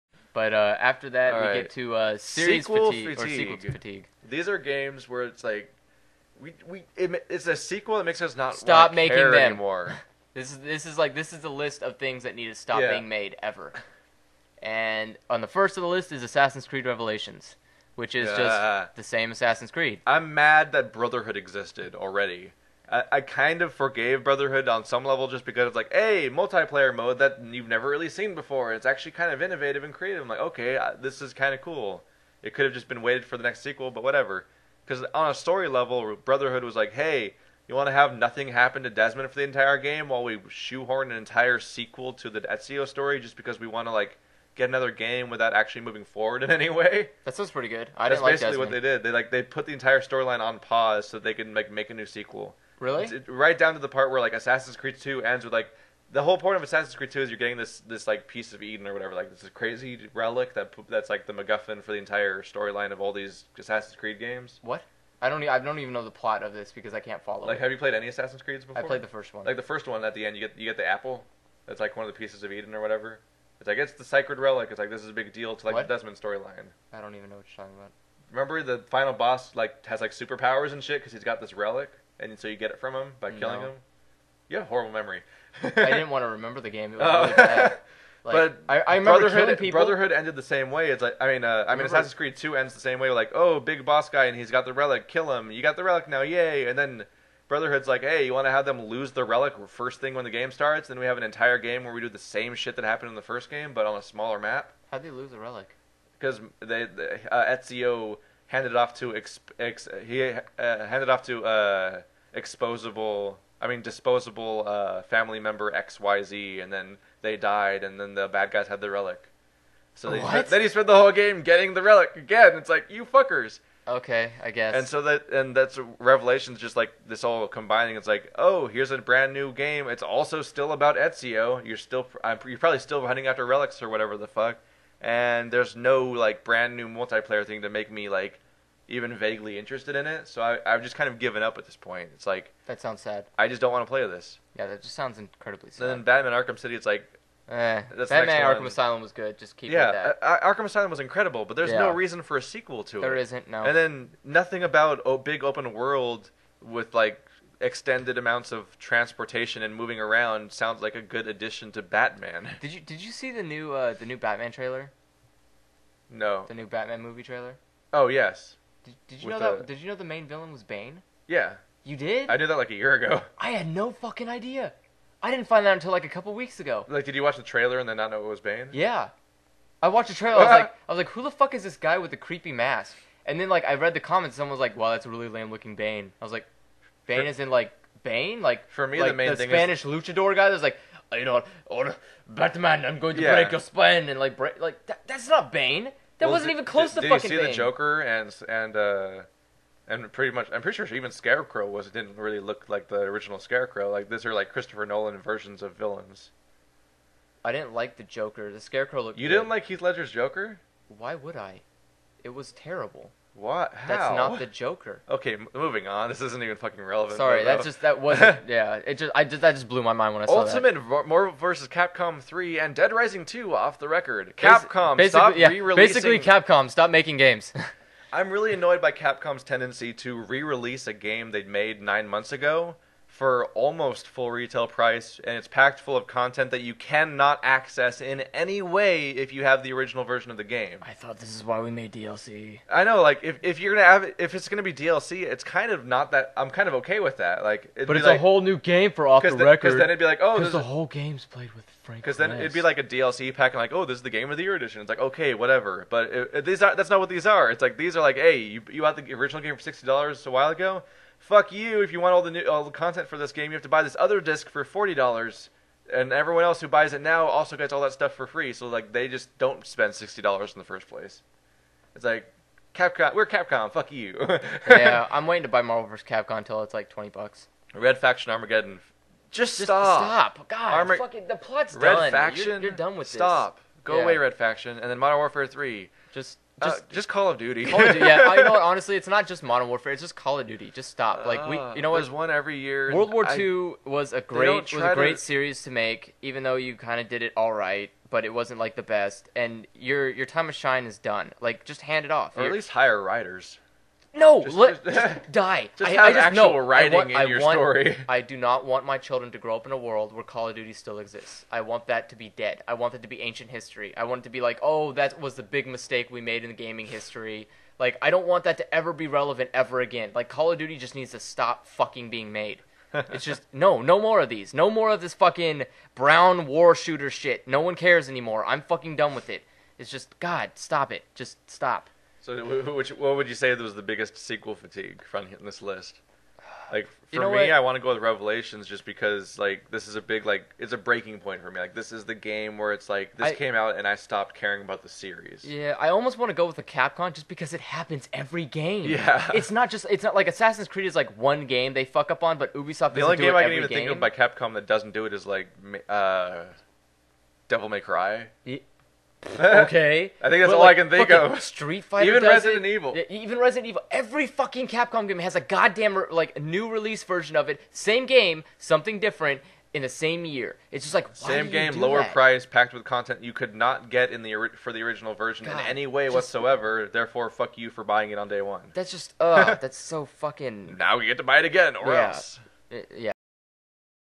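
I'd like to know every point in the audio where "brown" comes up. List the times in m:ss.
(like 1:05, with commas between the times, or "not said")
5:25.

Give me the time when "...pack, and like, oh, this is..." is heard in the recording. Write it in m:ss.
4:13.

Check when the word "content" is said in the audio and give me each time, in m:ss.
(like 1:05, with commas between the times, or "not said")
3:56, 4:22, 6:12.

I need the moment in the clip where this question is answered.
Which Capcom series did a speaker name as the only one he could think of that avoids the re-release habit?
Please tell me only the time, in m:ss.
5:57.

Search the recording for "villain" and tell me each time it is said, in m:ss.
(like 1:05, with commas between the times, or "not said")
2:50, 3:25.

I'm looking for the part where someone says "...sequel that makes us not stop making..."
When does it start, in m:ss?
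0:07.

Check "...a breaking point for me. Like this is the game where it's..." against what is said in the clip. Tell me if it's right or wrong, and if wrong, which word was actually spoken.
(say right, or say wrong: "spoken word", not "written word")
right.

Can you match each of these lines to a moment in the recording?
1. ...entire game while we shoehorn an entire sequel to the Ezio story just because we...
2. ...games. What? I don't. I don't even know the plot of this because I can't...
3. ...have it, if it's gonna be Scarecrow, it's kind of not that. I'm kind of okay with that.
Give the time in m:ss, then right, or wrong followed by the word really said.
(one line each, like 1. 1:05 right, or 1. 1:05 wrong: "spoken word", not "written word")
1. 0:39 right
2. 1:04 right
3. 4:03 wrong: "DLC", not "Scarecrow".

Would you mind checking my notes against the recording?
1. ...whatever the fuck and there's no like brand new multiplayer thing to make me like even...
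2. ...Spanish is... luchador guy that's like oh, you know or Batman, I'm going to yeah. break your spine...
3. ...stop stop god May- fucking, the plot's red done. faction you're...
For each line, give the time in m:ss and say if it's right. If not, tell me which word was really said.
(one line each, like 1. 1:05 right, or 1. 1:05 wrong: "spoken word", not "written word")
1. 2:13 right
2. 3:09 right
3. 4:39 wrong: "Armor", not "May".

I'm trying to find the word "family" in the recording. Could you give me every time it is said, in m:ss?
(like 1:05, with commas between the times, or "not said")
1:55.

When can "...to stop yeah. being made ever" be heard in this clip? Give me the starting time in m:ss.
0:12.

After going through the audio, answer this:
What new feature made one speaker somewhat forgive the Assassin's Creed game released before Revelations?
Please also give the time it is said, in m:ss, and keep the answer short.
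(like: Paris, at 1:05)
Multiplayer mode, at 0:26.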